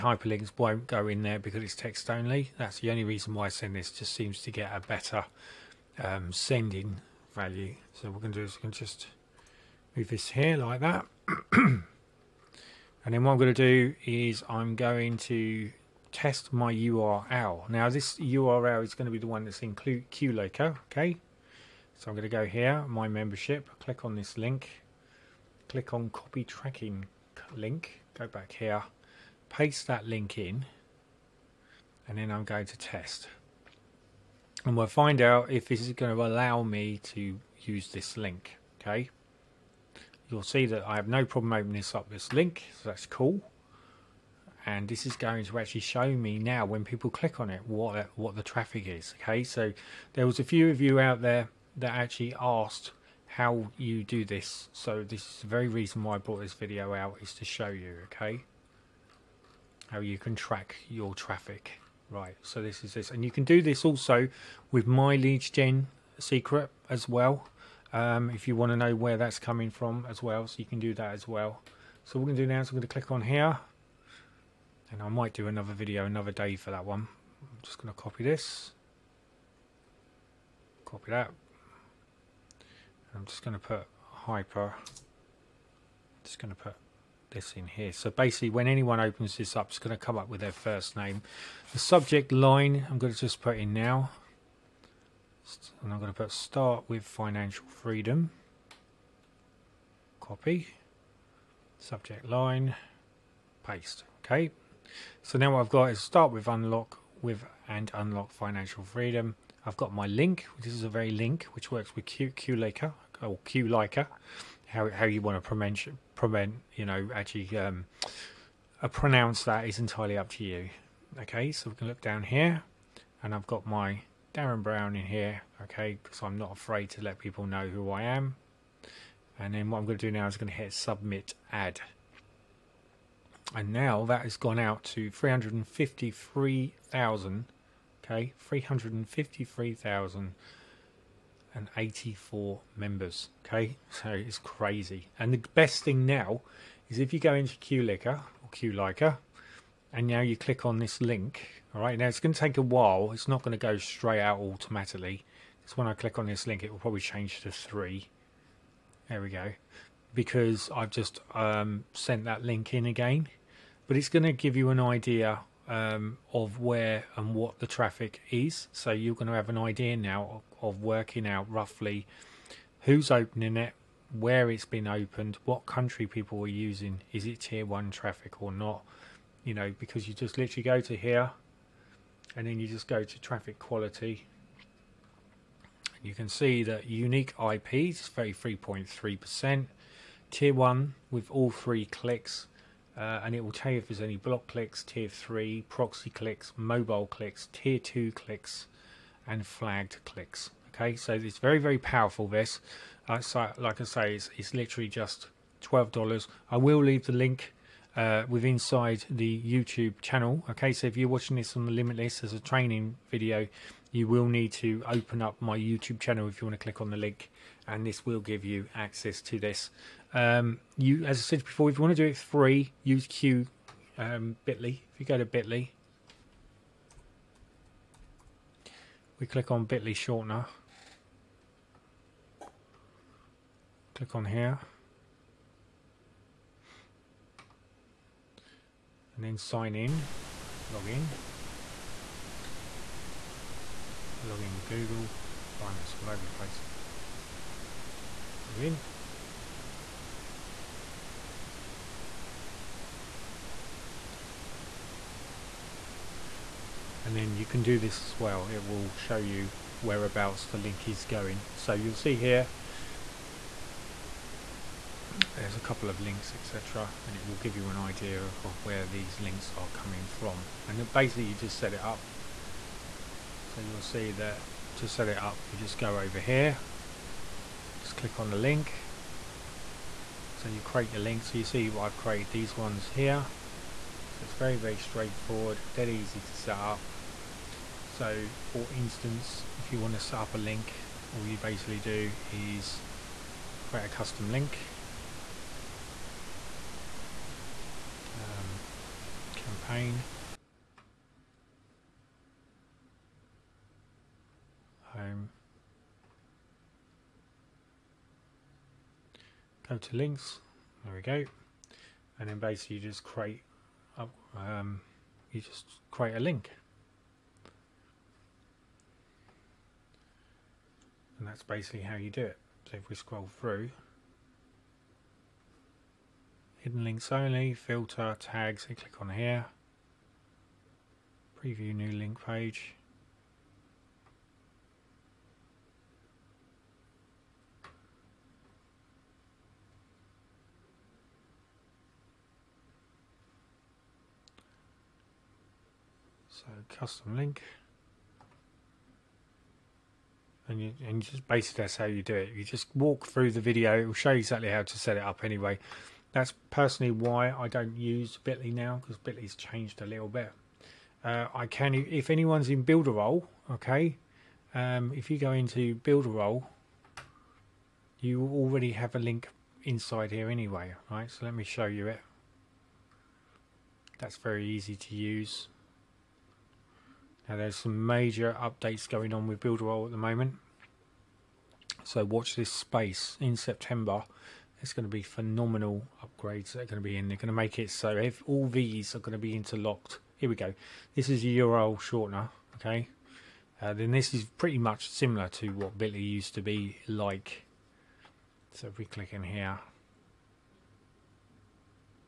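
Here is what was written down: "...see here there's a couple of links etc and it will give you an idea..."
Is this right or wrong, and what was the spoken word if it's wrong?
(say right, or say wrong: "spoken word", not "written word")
right.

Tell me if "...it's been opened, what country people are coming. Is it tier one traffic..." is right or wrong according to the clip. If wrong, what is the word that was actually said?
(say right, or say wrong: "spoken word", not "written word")
wrong: "using", not "coming".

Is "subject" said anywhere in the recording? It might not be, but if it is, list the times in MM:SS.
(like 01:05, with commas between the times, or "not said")
01:31, 01:41.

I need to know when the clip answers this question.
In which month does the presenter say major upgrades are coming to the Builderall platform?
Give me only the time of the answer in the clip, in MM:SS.
06:23.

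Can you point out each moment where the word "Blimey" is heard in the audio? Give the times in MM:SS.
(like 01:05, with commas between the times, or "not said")
04:05.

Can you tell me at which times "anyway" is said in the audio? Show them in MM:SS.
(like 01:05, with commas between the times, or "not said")
05:55, 06:10.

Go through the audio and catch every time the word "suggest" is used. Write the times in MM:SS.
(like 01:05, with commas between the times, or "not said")
not said.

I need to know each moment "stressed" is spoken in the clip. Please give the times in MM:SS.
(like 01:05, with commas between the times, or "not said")
not said.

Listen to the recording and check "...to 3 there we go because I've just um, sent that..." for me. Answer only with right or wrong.
right.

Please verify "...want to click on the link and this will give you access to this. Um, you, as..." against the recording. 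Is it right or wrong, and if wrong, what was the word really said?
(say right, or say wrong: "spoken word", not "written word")
right.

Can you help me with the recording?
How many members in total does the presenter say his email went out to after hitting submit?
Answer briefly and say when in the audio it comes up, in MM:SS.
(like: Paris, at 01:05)
353,084, at 02:18.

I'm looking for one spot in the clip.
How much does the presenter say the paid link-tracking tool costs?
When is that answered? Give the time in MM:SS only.
03:25.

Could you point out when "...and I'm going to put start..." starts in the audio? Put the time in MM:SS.
01:35.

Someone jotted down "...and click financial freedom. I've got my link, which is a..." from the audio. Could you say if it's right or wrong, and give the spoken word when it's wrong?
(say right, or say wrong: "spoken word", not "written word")
wrong: "unlock", not "click".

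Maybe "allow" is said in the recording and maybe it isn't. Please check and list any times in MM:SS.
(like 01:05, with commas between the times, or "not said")
00:36.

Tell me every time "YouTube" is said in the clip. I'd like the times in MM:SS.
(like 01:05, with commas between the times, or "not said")
03:29, 03:35.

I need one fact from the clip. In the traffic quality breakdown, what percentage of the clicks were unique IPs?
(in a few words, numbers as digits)
33.3%.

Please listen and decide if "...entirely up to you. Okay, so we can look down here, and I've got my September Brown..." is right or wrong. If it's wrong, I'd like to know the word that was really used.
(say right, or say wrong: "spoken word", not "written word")
wrong: "Darren", not "September".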